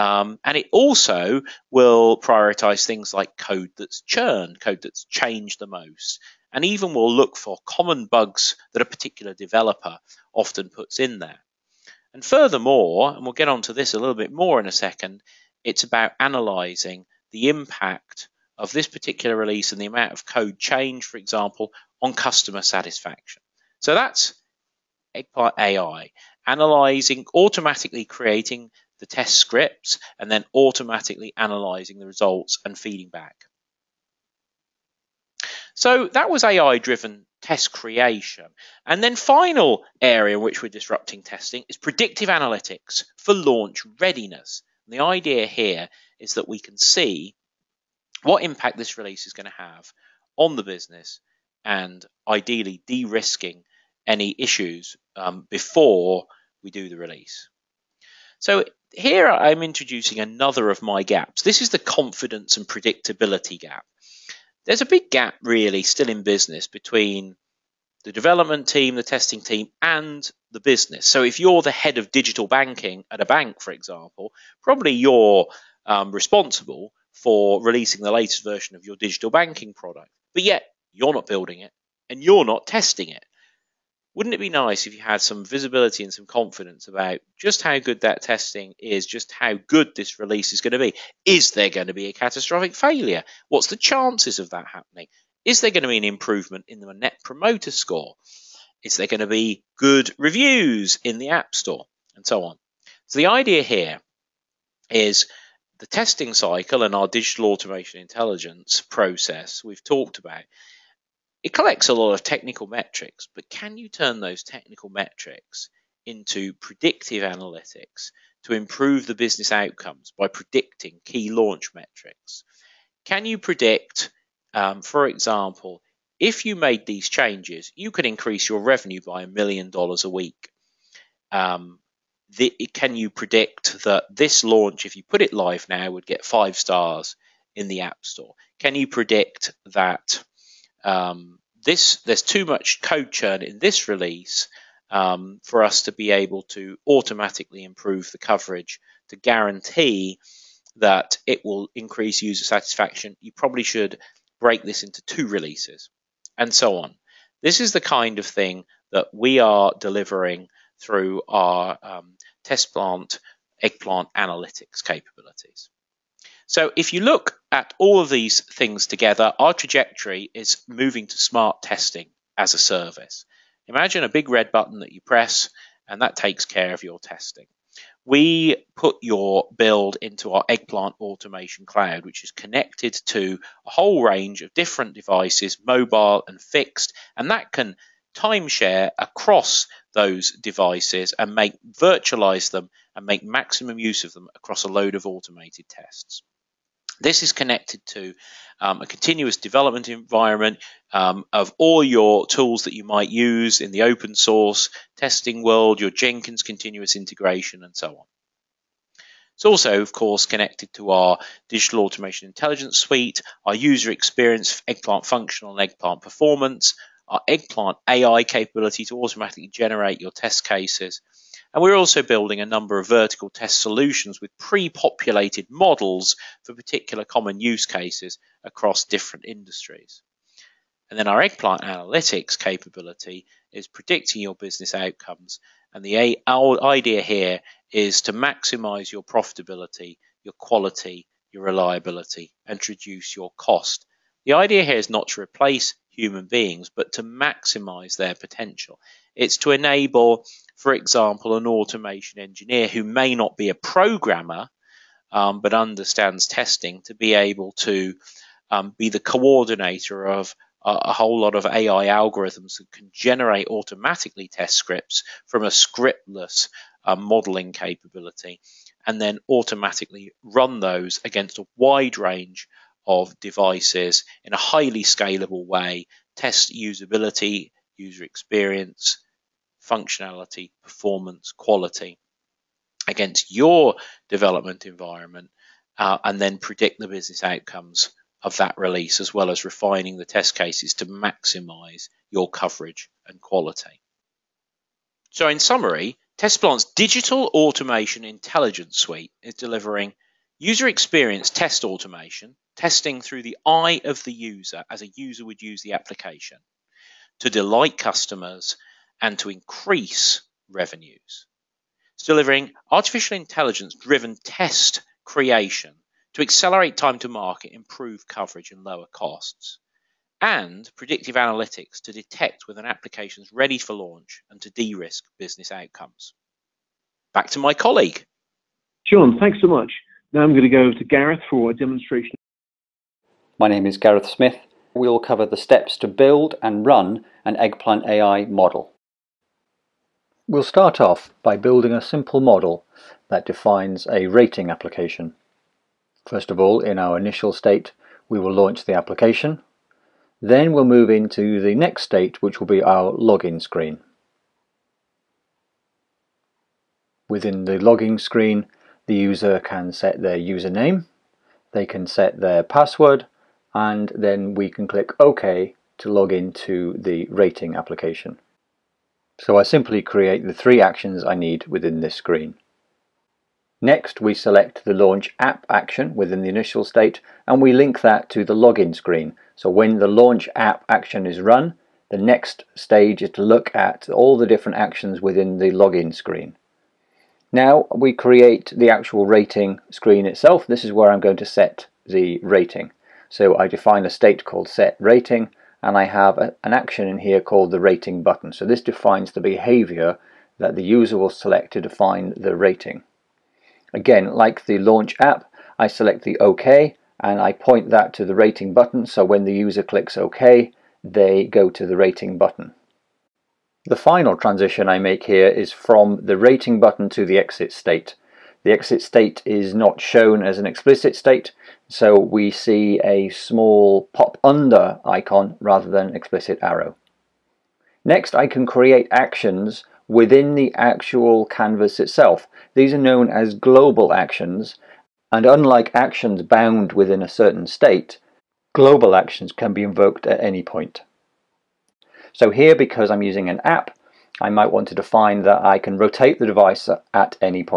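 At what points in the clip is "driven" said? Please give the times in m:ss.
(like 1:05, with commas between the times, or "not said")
0:36, 5:13.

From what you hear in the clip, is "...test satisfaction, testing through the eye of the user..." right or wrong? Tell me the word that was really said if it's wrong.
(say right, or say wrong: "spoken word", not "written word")
wrong: "automation", not "satisfaction".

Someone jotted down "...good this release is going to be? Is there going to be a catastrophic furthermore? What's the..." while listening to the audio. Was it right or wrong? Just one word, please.
wrong.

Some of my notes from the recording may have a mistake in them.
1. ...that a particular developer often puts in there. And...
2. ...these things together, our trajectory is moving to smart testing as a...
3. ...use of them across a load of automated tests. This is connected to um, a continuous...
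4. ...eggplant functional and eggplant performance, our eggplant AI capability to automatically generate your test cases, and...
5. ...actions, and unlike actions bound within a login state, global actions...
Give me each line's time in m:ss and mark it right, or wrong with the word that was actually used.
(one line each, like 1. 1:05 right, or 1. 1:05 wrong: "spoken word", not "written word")
1. 0:08 right
2. 2:48 right
3. 3:13 right
4. 3:34 right
5. 7:13 wrong: "certain", not "login".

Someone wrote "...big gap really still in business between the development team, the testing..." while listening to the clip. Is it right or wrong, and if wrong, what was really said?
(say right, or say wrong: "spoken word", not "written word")
right.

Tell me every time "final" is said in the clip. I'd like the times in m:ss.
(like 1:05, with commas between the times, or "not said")
0:39, 6:53.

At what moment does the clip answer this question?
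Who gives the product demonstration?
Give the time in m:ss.
5:33.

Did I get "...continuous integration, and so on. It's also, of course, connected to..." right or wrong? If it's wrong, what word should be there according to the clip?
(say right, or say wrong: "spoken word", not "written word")
right.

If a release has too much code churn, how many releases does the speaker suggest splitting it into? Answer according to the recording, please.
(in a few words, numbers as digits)
2.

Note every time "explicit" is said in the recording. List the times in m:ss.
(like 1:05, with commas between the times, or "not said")
7:00, 7:05.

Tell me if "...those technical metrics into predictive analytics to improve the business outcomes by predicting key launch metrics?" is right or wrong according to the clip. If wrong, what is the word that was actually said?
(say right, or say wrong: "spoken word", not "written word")
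right.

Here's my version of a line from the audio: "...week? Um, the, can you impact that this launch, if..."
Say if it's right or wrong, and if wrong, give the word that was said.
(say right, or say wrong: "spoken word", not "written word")
wrong: "predict", not "impact".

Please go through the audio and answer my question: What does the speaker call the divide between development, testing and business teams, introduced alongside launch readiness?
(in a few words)
confidence and predictability gap.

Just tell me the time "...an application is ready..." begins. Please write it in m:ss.
5:22.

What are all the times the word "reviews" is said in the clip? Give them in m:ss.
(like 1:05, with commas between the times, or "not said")
1:40.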